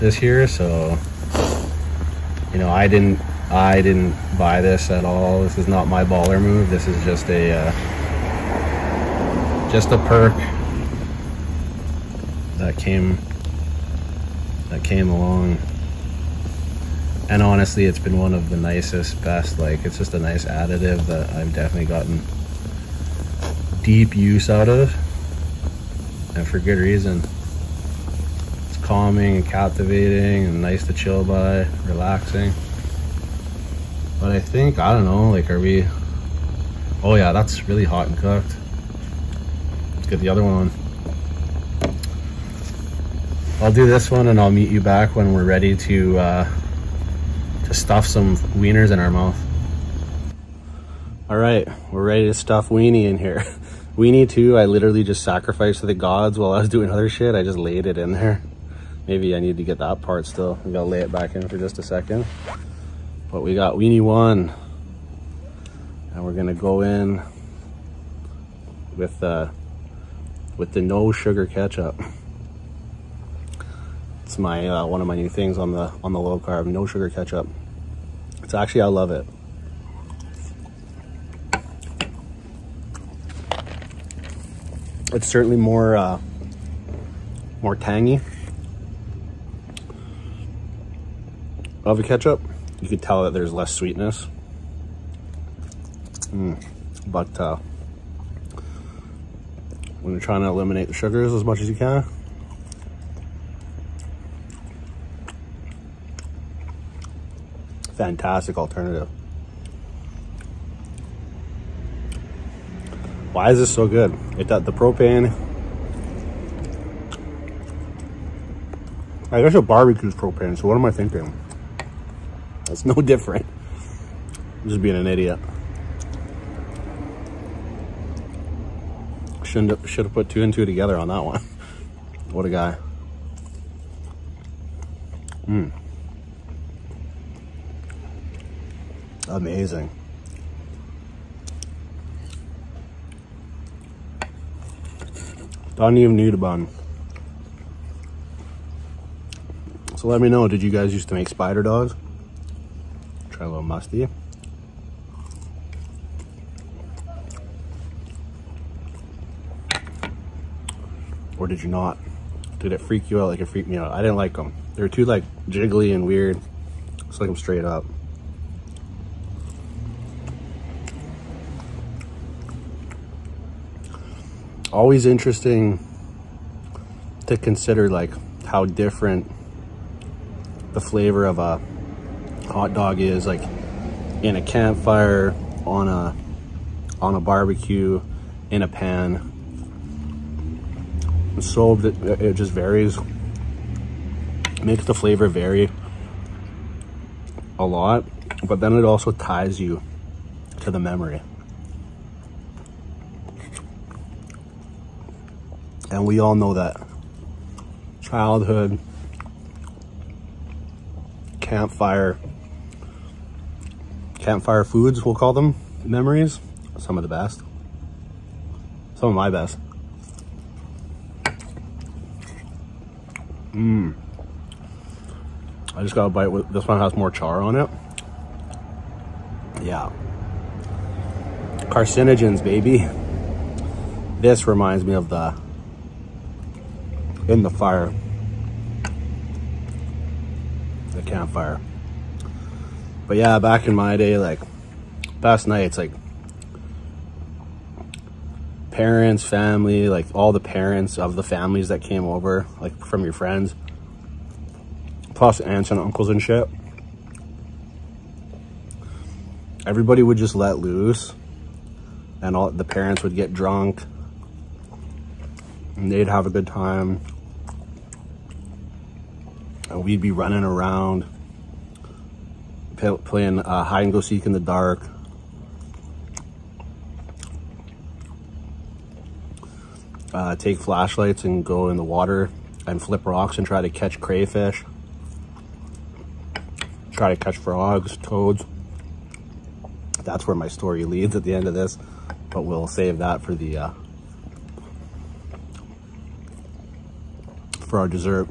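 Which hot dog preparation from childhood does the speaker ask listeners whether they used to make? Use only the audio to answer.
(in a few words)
spider dogs.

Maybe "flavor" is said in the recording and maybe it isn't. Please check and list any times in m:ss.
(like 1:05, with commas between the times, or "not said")
3:00, 3:14.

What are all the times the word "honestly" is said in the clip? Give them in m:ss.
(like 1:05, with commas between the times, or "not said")
0:17.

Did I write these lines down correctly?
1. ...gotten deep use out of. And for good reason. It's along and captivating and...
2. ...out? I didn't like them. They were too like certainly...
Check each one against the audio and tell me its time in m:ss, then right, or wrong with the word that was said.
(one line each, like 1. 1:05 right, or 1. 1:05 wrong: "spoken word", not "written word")
1. 0:21 wrong: "calming", not "along"
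2. 2:43 wrong: "jiggly", not "certainly".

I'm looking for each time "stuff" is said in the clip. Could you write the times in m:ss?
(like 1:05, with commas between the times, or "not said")
0:47, 0:52.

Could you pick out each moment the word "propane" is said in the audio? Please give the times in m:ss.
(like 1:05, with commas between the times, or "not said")
1:54, 2:00.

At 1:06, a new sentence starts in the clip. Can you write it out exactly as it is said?
And we're gonna go in with, uh, with the no sugar ketchup.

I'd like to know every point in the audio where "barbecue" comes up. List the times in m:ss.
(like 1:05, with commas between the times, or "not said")
1:59, 3:07.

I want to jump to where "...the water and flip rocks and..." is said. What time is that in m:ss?
4:41.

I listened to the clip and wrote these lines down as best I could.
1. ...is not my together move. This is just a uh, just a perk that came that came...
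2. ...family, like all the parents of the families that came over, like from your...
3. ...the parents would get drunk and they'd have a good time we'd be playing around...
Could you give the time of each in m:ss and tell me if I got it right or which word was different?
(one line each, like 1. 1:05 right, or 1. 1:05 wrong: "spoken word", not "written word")
1. 0:05 wrong: "baller", not "together"
2. 4:09 right
3. 4:22 wrong: "running", not "playing".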